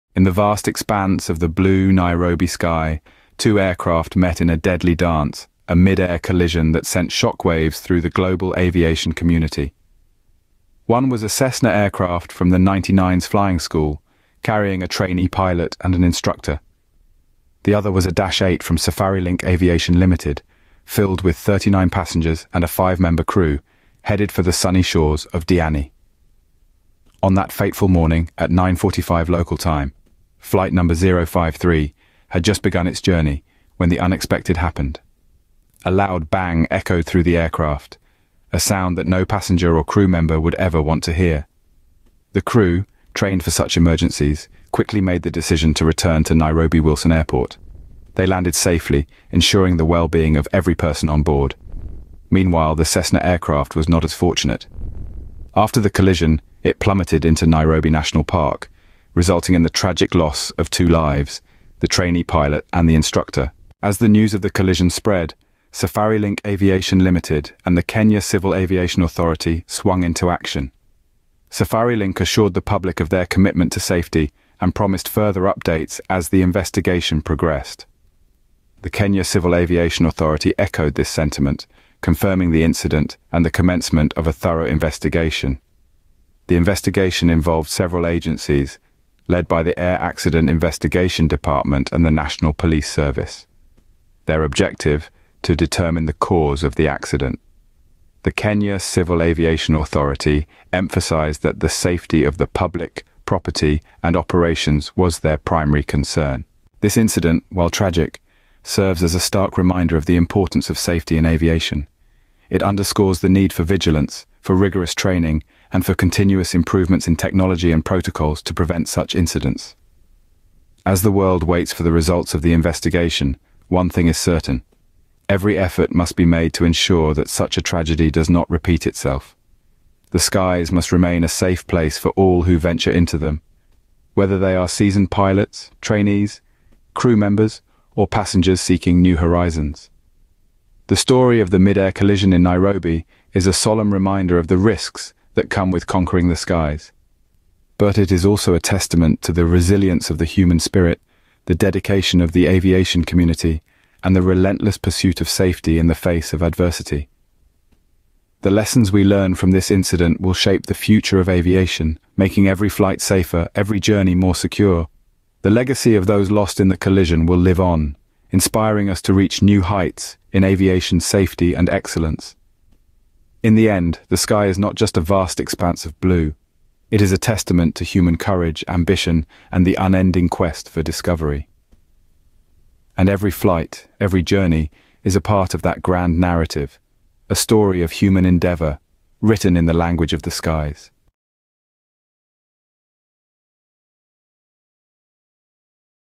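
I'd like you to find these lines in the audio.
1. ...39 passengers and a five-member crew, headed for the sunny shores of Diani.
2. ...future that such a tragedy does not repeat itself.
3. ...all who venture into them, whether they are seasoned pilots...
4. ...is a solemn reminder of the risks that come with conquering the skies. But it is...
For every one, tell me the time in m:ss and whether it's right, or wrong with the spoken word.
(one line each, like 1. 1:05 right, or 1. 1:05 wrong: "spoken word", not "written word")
1. 0:21 right
2. 2:06 wrong: "ensure", not "future"
3. 2:12 right
4. 2:23 right.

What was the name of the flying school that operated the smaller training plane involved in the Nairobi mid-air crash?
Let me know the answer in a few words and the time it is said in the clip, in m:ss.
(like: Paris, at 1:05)
99's flying school, at 0:12.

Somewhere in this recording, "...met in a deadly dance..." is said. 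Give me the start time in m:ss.
0:04.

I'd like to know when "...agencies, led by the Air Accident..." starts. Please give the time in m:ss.
1:28.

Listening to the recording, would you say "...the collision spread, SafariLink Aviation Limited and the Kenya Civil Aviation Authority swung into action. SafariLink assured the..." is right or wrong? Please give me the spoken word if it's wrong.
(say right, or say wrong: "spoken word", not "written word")
right.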